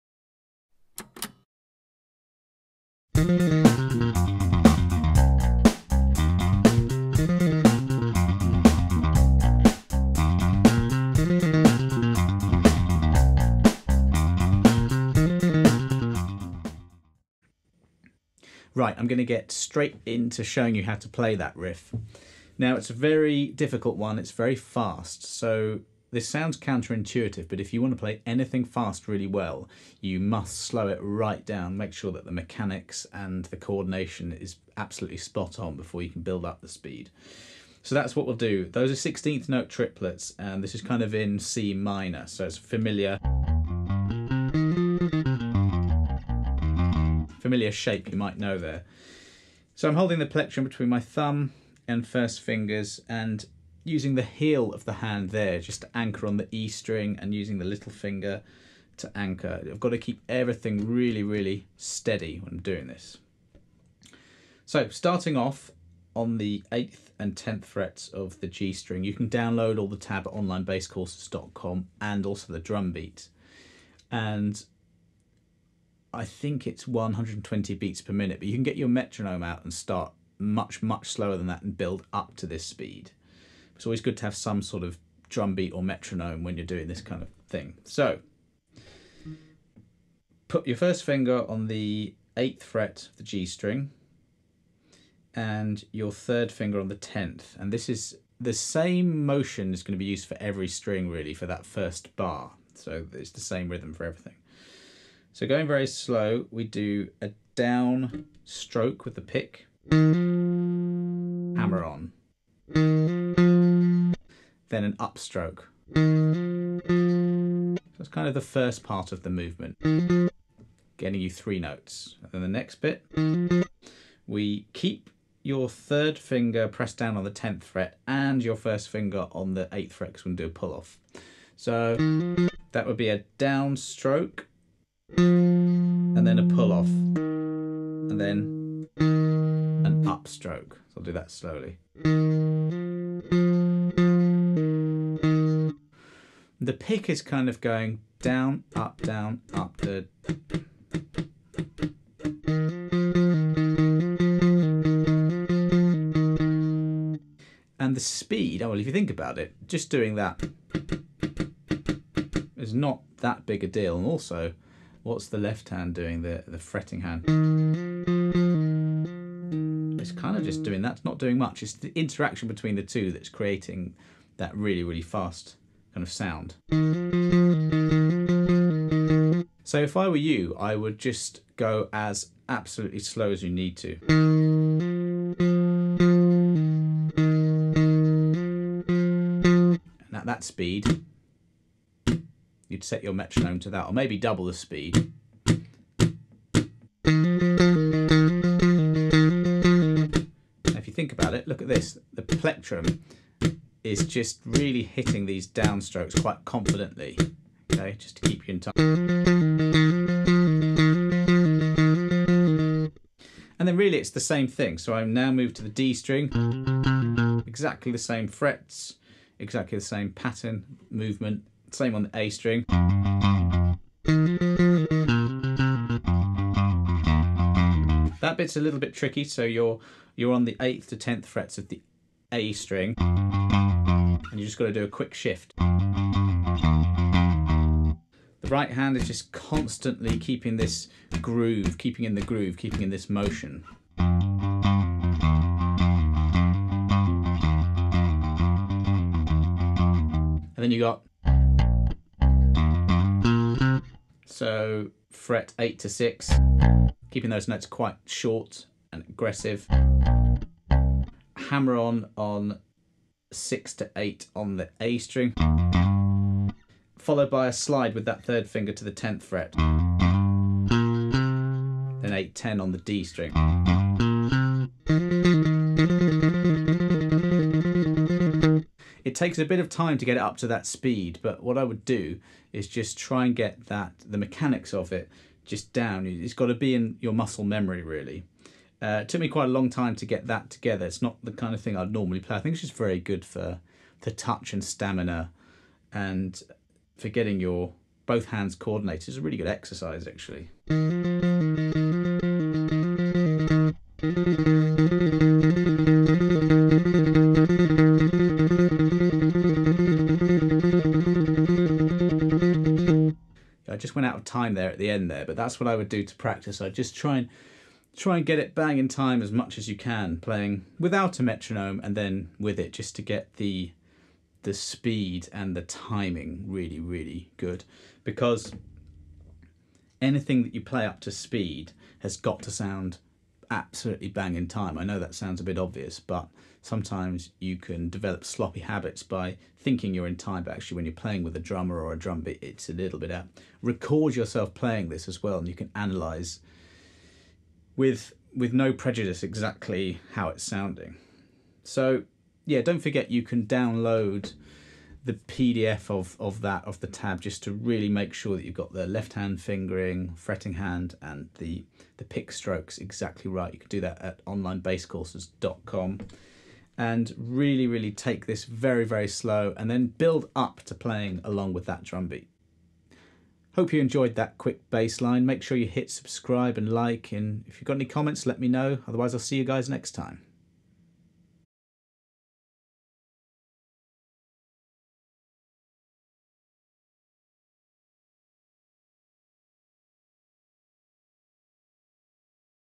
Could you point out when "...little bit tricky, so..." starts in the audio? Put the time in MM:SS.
03:48.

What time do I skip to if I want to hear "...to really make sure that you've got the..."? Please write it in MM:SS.
05:57.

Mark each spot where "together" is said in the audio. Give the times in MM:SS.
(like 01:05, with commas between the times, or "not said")
04:50.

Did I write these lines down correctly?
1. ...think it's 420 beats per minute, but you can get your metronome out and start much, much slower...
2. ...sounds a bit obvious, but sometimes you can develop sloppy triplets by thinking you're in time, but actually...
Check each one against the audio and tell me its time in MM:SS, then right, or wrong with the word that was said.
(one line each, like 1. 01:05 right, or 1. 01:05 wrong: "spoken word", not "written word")
1. 01:16 wrong: "120", not "420"
2. 05:35 wrong: "habits", not "triplets".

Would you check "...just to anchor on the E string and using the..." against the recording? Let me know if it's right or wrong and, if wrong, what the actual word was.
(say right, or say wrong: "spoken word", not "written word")
right.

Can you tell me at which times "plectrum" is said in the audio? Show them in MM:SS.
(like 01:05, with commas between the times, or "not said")
00:50, 03:22.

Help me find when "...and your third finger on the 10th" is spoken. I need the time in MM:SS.
01:35.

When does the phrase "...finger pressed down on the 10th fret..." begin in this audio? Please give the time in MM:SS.
02:06.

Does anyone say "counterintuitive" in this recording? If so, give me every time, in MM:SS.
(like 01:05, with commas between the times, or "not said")
00:26.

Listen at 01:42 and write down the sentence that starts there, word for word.
So it's the same rhythm for everything.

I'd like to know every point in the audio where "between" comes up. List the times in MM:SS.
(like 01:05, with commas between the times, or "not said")
00:50, 02:52.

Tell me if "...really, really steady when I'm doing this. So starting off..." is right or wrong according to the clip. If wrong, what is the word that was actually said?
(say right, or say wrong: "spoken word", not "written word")
right.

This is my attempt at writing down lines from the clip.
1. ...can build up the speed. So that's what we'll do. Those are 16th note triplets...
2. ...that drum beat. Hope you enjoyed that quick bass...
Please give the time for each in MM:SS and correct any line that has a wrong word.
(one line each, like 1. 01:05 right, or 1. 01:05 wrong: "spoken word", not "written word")
1. 00:36 right
2. 06:11 right.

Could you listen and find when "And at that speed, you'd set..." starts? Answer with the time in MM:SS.
03:10.